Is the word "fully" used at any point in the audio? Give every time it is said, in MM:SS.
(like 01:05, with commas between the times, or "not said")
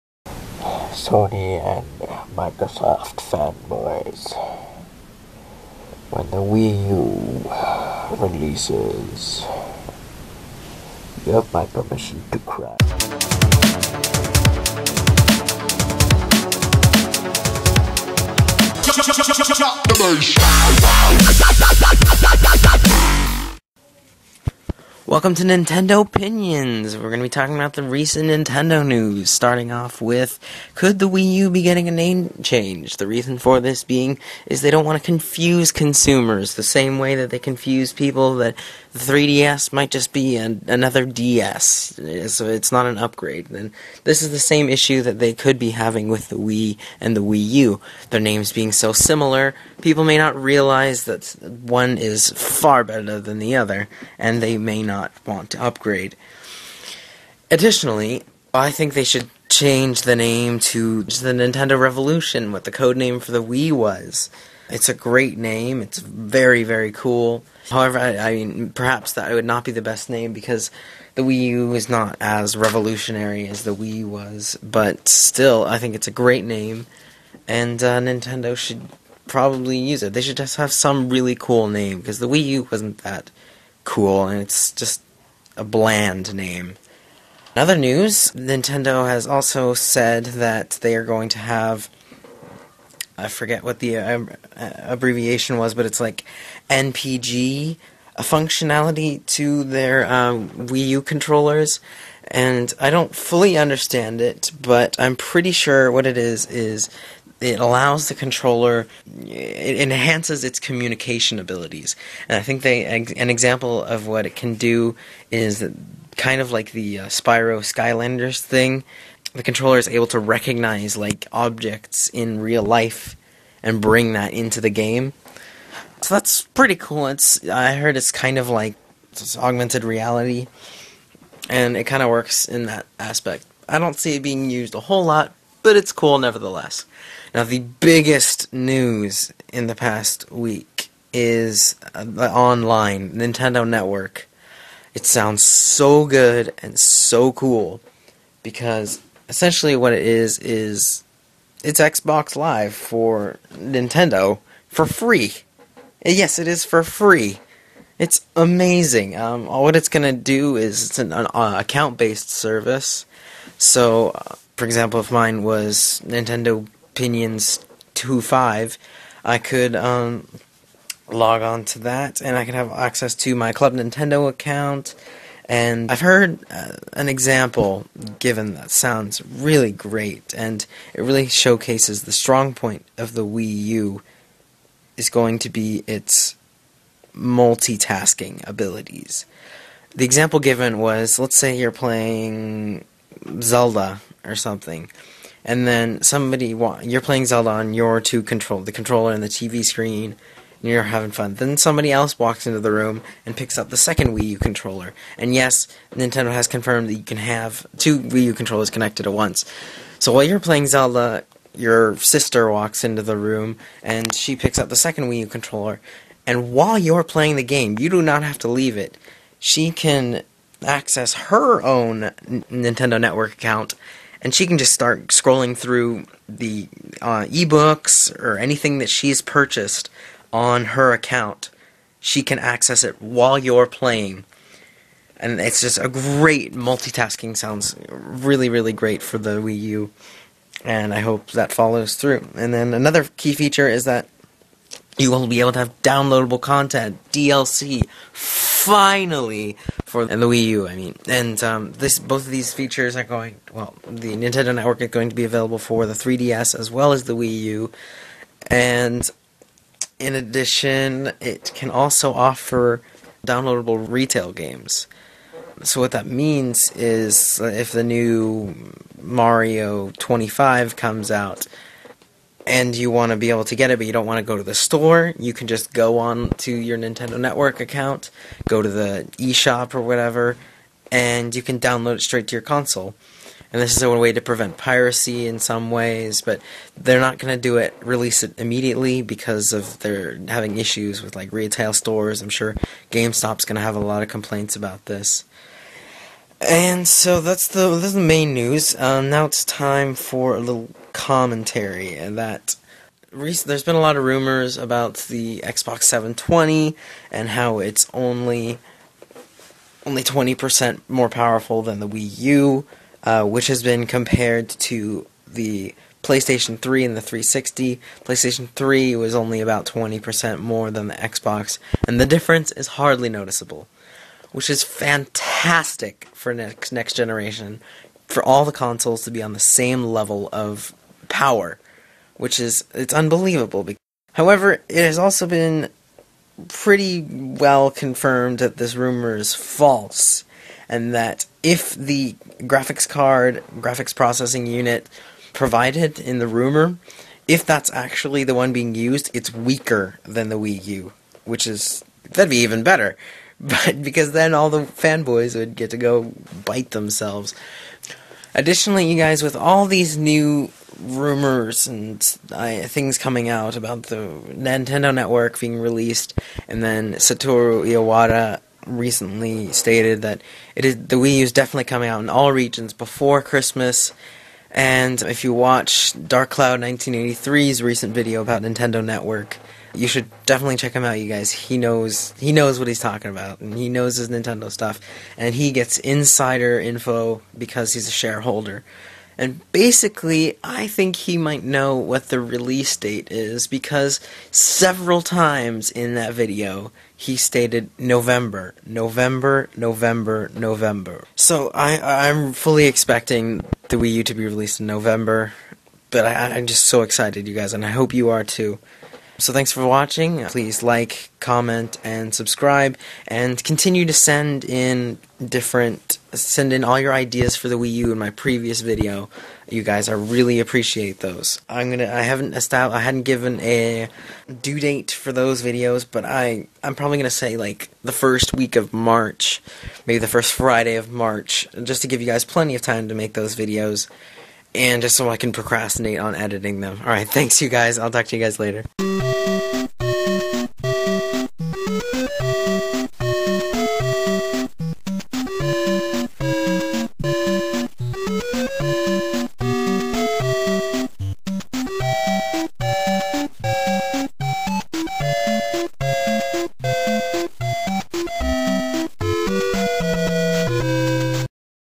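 01:43, 06:42.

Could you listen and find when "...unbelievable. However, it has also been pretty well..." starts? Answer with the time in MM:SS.
05:32.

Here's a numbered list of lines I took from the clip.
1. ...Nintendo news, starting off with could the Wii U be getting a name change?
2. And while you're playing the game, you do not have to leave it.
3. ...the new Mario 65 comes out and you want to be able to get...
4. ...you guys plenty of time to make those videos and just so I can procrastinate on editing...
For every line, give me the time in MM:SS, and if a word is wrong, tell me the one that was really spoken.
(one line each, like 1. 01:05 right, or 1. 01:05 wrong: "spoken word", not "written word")
1. 00:28 right
2. 03:36 right
3. 04:27 wrong: "25", not "65"
4. 07:12 right.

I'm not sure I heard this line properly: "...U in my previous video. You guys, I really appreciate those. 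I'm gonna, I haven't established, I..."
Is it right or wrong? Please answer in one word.
right.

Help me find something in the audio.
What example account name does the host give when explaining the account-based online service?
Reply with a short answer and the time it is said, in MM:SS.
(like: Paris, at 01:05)
Nintendo Opinions 25, at 02:46.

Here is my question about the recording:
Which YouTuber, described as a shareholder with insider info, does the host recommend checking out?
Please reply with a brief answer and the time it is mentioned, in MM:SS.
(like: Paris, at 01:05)
Dark Cloud 1983, at 06:16.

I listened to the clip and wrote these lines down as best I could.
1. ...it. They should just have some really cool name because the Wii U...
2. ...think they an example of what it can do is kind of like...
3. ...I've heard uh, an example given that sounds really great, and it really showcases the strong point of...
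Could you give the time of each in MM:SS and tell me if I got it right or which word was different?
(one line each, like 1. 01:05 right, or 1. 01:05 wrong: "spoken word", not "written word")
1. 01:20 right
2. 01:52 right
3. 02:55 right.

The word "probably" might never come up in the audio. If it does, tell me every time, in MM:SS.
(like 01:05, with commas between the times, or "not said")
01:19, 07:06.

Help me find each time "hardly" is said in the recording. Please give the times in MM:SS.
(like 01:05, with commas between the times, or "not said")
05:22.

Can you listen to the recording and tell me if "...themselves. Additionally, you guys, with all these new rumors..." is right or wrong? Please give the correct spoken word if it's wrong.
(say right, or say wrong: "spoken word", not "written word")
right.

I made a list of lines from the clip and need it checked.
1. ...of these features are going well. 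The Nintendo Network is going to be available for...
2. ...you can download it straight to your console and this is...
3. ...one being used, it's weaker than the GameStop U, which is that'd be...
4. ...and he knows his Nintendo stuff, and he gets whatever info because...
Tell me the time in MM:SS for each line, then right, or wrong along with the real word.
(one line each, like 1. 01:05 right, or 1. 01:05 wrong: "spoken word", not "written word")
1. 04:12 right
2. 04:41 right
3. 05:48 wrong: "Wii", not "GameStop"
4. 06:23 wrong: "insider", not "whatever".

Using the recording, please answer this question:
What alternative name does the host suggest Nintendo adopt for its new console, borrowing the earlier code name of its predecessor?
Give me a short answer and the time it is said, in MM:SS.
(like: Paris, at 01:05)
Nintendo Revolution, at 01:01.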